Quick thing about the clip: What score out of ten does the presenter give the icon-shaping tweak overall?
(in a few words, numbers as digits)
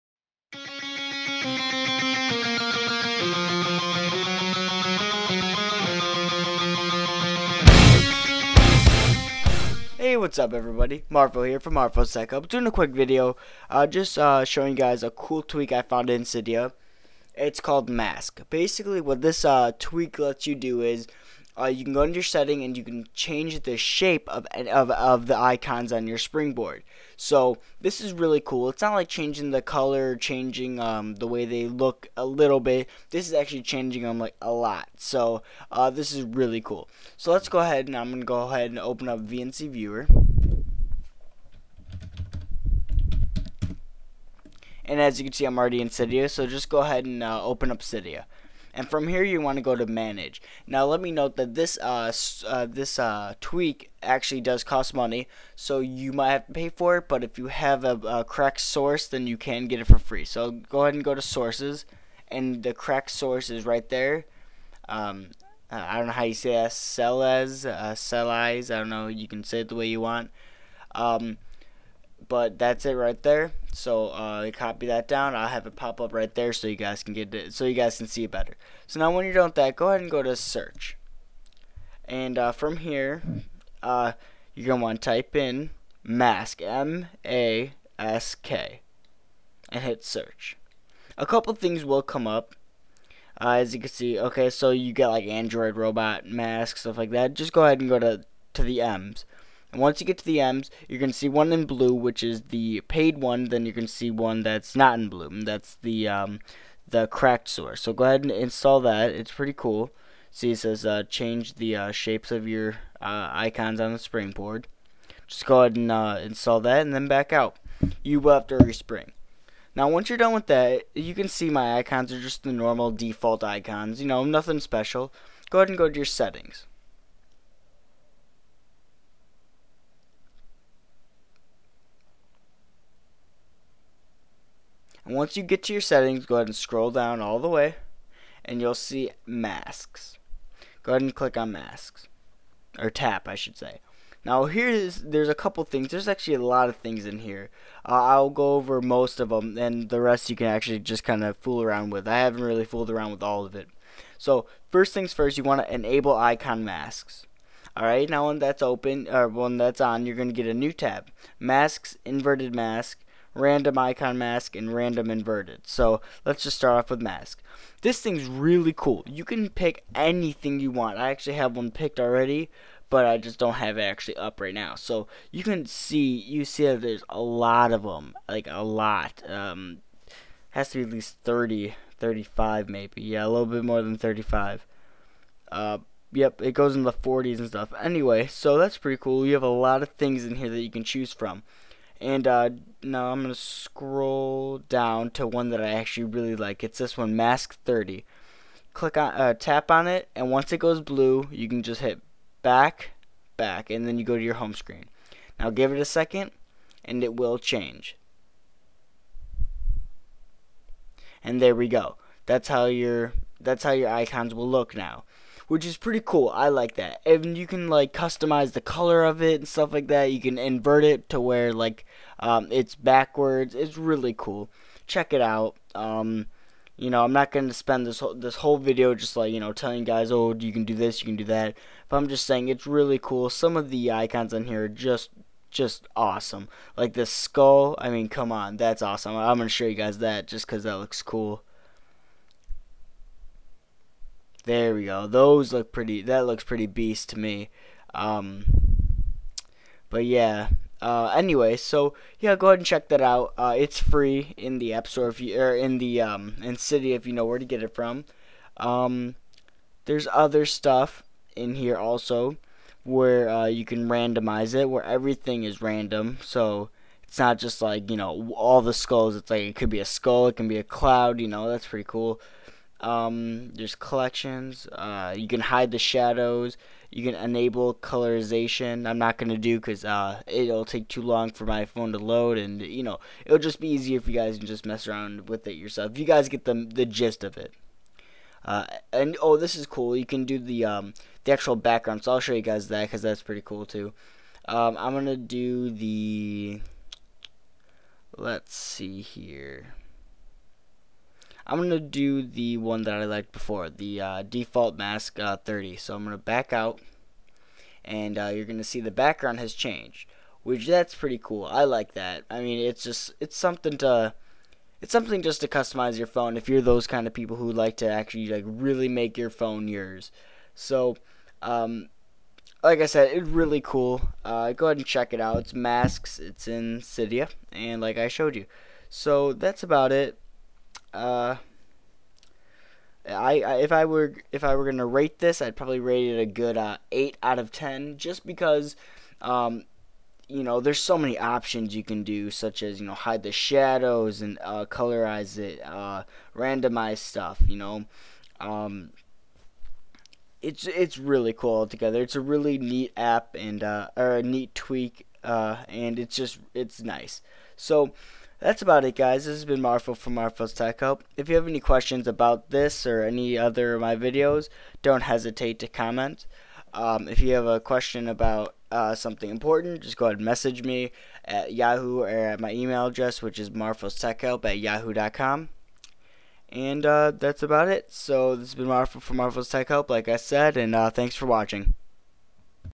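8.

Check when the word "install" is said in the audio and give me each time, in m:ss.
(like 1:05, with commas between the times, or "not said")
1:48, 1:56.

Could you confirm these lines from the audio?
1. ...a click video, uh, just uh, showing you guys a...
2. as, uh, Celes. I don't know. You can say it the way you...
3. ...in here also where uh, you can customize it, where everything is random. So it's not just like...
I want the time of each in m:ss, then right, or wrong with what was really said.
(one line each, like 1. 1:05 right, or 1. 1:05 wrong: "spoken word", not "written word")
1. 0:12 wrong: "quick", not "click"
2. 1:06 right
3. 4:21 wrong: "randomize", not "customize".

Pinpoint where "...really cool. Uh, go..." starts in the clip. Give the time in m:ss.
5:23.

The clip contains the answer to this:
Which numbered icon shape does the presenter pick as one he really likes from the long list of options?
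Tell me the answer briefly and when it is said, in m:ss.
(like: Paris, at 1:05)
Mask 30, at 3:17.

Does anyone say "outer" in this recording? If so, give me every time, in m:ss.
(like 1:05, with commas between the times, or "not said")
not said.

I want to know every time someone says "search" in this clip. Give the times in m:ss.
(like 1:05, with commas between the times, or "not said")
1:20, 1:30.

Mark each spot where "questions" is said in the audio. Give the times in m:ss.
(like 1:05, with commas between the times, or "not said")
6:01, 6:07.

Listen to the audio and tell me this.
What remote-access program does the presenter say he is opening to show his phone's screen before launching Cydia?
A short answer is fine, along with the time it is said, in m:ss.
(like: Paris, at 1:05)
VNC Viewer, at 0:39.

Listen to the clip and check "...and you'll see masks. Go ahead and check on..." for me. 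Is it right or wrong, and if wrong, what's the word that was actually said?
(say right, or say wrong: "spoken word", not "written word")
wrong: "click", not "check".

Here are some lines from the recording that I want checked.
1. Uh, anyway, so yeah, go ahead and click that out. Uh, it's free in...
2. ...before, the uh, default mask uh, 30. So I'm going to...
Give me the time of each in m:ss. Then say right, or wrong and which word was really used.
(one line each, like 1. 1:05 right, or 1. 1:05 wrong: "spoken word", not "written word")
1. 4:10 wrong: "check", not "click"
2. 5:03 right.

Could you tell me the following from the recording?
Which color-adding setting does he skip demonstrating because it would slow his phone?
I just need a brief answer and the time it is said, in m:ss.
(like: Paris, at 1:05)
Colorization, at 4:37.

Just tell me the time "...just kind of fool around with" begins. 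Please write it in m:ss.
2:30.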